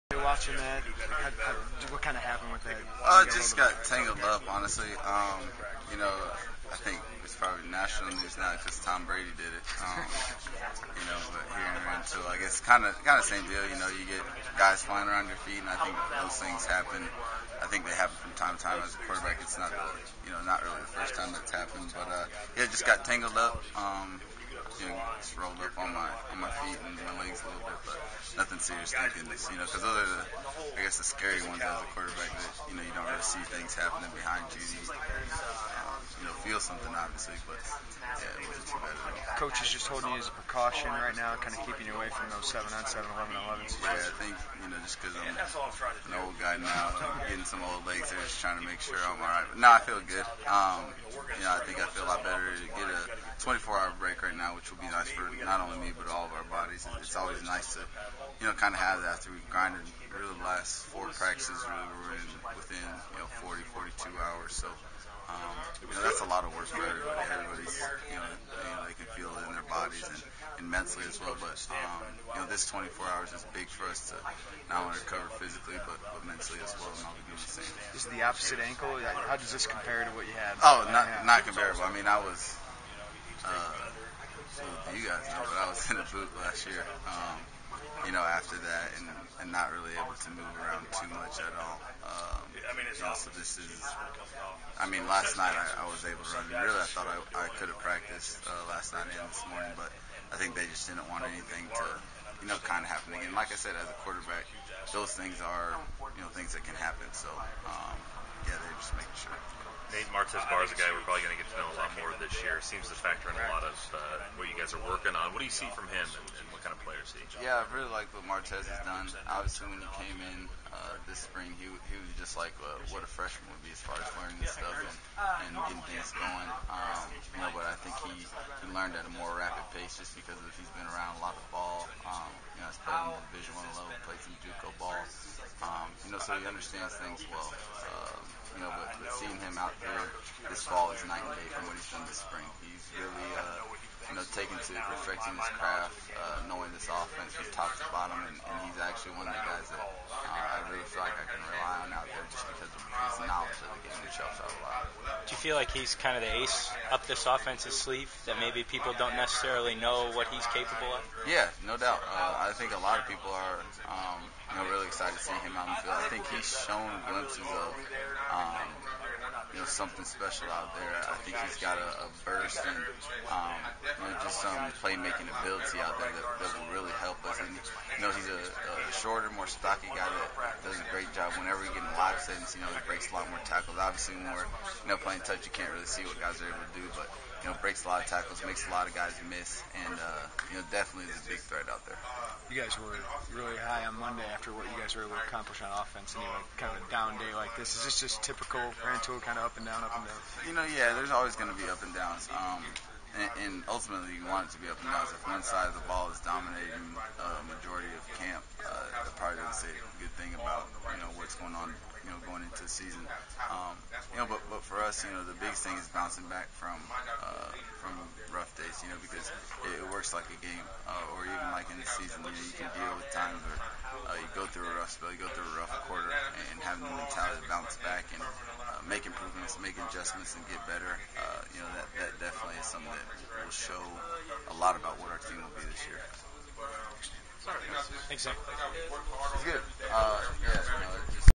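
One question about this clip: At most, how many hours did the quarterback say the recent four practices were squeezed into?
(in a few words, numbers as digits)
42 hours.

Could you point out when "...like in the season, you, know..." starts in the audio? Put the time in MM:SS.
03:41.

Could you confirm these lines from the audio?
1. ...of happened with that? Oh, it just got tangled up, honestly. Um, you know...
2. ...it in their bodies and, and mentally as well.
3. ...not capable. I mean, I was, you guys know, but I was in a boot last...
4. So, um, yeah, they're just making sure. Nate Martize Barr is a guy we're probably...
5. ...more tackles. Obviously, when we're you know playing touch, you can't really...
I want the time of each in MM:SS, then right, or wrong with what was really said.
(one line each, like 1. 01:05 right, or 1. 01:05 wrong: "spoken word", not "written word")
1. 00:02 right
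2. 01:09 right
3. 01:21 wrong: "comparable", not "capable"
4. 01:47 right
5. 03:03 right.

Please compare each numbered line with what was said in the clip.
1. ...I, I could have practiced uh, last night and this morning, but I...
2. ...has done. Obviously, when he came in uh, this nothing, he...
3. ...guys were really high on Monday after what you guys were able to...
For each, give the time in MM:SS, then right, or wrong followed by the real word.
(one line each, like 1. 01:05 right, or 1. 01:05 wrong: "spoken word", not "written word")
1. 01:37 right
2. 01:58 wrong: "spring", not "nothing"
3. 03:12 right.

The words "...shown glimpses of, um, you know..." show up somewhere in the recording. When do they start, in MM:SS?
02:46.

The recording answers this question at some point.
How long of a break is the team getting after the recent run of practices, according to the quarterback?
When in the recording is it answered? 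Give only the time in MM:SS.
00:53.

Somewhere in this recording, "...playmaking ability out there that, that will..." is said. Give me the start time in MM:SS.
02:54.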